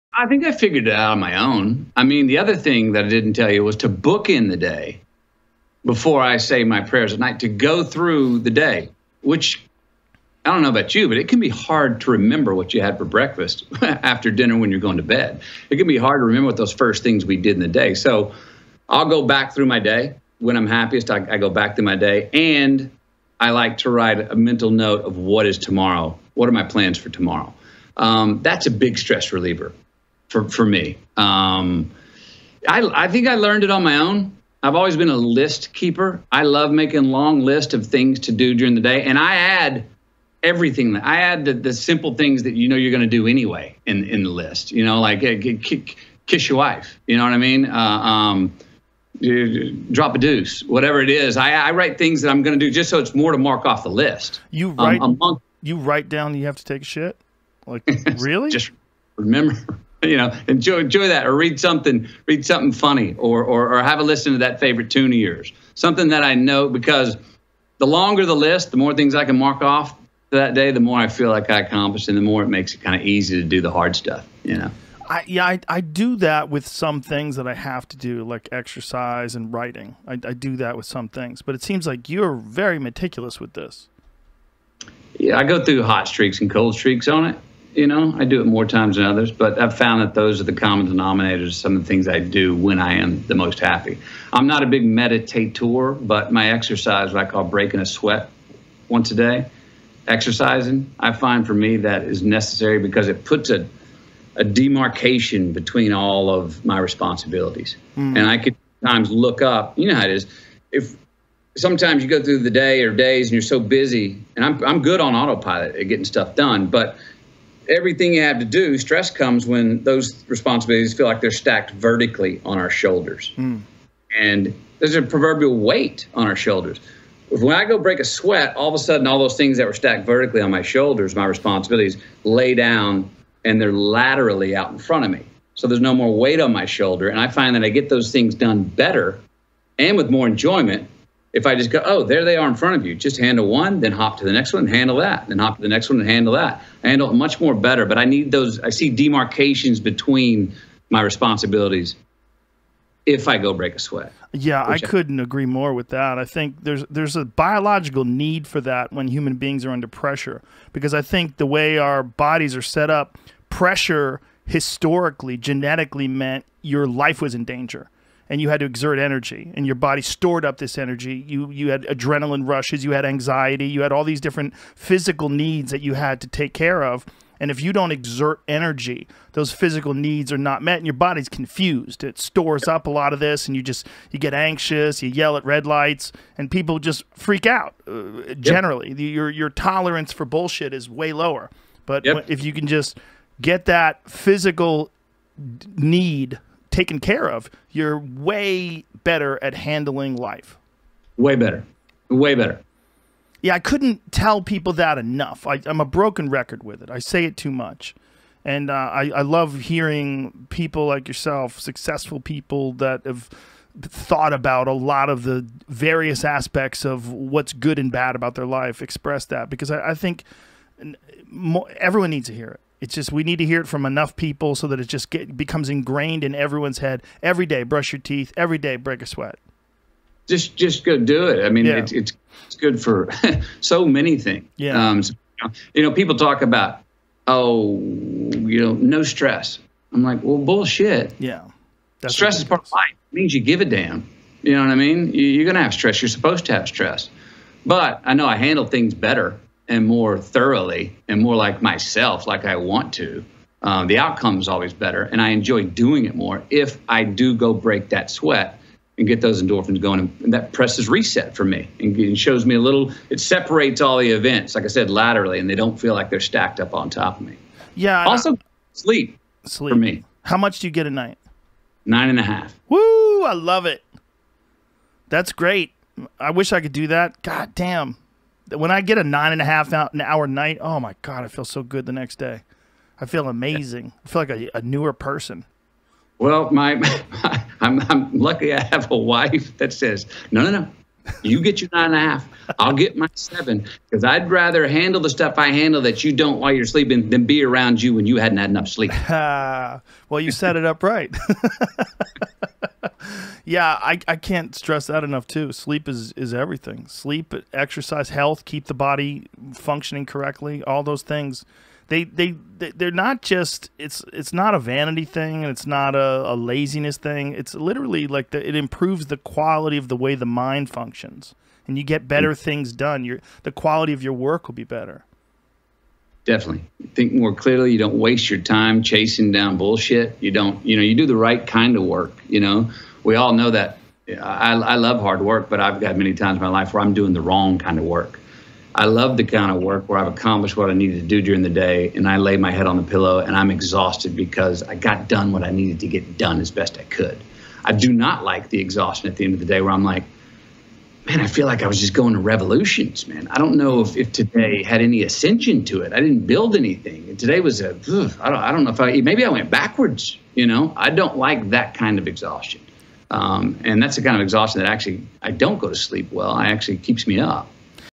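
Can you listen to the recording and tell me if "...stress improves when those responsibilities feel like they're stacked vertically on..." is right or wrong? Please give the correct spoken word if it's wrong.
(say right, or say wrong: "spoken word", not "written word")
wrong: "comes", not "improves".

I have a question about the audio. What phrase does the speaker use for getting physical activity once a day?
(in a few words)
breaking a sweat.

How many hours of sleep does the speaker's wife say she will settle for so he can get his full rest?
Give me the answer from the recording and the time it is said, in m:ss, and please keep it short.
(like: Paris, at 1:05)
7, at 4:53.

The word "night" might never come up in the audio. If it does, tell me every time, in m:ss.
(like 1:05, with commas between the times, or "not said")
0:07, 4:30, 4:40.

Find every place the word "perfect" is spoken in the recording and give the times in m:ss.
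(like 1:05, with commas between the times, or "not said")
not said.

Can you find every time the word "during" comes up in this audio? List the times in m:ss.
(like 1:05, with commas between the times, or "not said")
0:38, 5:41.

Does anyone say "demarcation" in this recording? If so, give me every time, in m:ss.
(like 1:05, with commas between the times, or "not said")
1:44, 2:28.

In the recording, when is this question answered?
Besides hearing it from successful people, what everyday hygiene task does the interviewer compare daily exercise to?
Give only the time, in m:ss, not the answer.
3:47.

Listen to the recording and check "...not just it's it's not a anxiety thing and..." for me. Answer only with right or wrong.
wrong.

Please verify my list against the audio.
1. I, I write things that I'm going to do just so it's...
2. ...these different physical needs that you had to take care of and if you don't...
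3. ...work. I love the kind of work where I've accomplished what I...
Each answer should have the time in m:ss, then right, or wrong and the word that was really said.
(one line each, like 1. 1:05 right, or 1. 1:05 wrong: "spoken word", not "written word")
1. 0:51 right
2. 2:54 right
3. 5:37 right.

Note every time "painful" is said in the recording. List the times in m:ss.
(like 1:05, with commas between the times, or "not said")
not said.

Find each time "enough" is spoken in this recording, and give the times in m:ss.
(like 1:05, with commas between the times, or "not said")
3:24, 3:43, 4:58, 5:05.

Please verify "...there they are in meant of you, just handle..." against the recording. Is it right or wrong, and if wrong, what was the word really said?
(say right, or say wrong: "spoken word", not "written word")
wrong: "front", not "meant".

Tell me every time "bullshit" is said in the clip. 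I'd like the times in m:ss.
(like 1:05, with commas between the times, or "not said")
3:10, 4:00, 5:29.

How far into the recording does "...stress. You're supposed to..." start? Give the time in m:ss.
4:05.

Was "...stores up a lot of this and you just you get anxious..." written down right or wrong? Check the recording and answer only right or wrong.
right.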